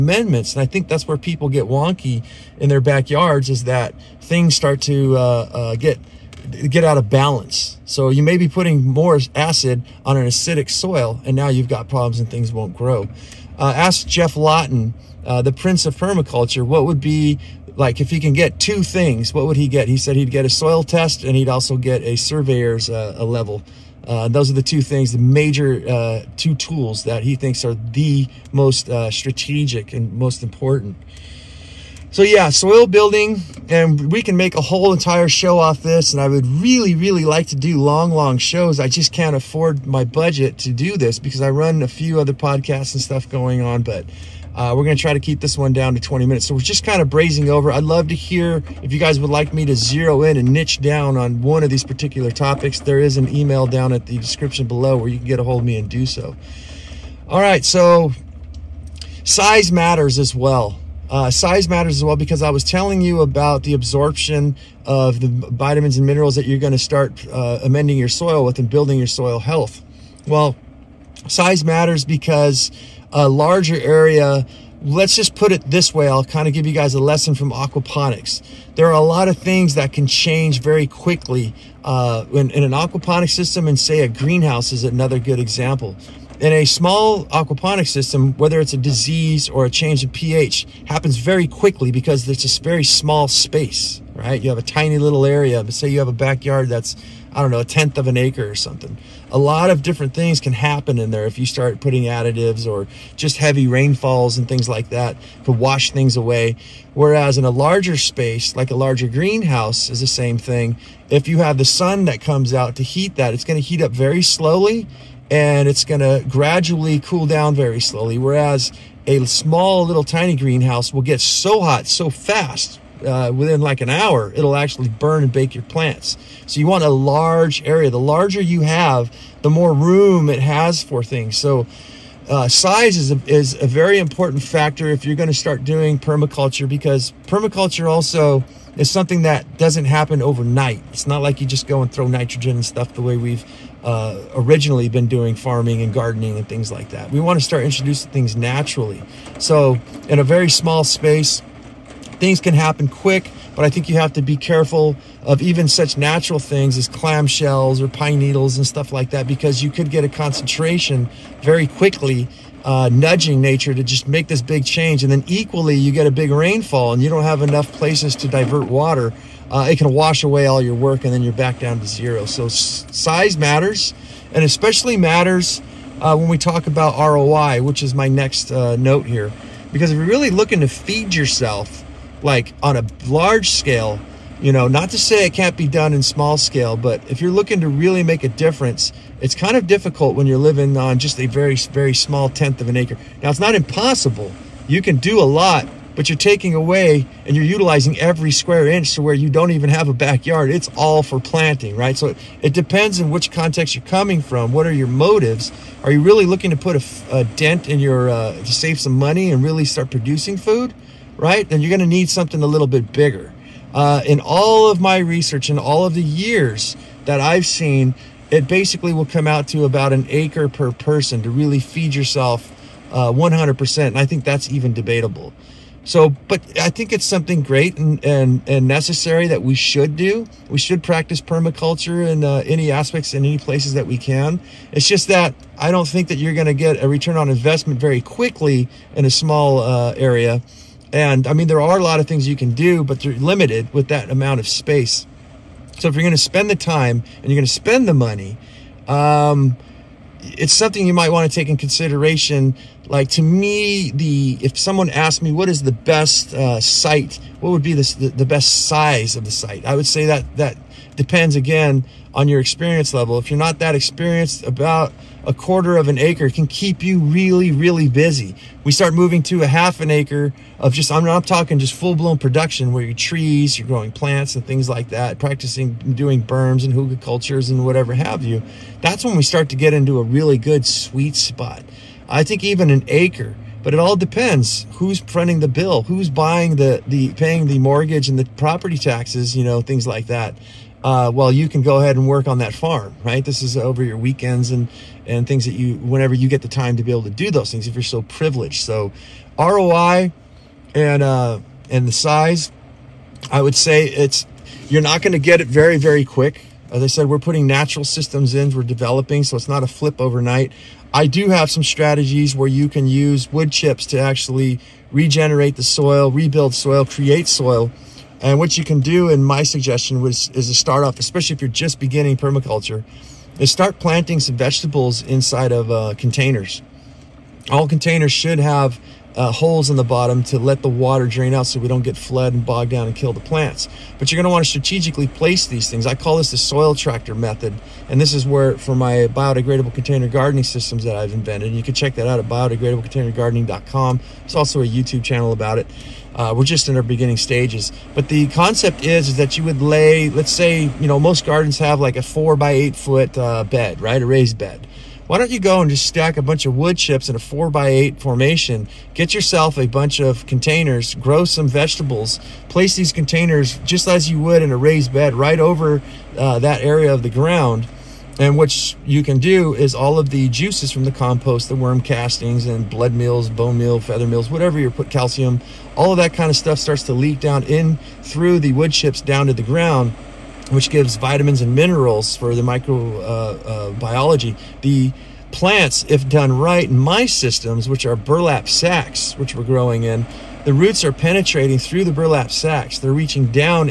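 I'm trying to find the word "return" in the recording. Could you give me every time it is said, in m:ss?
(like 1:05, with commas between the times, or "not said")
3:56.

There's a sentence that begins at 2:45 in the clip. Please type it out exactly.
And then equally, you get a big rainfall and you don't have enough places to divert water.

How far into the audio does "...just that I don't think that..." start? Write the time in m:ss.
3:54.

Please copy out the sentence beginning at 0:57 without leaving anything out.
All right, so size matters as well.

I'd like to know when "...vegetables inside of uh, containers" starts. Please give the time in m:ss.
5:24.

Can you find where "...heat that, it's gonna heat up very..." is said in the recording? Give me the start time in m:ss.
1:52.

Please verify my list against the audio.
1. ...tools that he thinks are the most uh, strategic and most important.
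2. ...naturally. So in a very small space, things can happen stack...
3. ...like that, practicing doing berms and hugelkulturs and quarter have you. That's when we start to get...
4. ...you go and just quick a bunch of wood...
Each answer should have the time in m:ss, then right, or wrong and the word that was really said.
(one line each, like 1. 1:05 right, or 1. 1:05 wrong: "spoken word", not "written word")
1. 0:26 right
2. 2:28 wrong: "quick", not "stack"
3. 4:34 wrong: "whatever", not "quarter"
4. 5:55 wrong: "stack", not "quick".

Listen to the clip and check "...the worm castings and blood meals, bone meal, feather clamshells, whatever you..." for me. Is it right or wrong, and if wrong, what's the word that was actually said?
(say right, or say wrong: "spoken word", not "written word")
wrong: "meals", not "clamshells".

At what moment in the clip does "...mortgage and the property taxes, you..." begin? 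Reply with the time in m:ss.
4:47.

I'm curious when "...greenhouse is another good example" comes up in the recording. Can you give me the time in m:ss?
1:24.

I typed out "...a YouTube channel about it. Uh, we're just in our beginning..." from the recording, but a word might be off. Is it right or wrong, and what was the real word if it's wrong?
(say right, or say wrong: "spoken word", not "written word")
right.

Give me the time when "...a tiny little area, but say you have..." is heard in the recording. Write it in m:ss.
1:34.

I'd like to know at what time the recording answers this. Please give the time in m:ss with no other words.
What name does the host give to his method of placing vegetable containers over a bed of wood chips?
5:36.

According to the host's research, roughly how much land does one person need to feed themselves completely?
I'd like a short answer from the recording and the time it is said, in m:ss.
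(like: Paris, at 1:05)
1 acre, at 3:39.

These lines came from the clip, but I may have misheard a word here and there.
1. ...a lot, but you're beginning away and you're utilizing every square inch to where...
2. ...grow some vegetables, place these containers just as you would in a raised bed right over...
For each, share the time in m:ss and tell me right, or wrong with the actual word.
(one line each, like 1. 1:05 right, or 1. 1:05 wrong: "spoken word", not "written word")
1. 3:15 wrong: "taking", not "beginning"
2. 6:00 right.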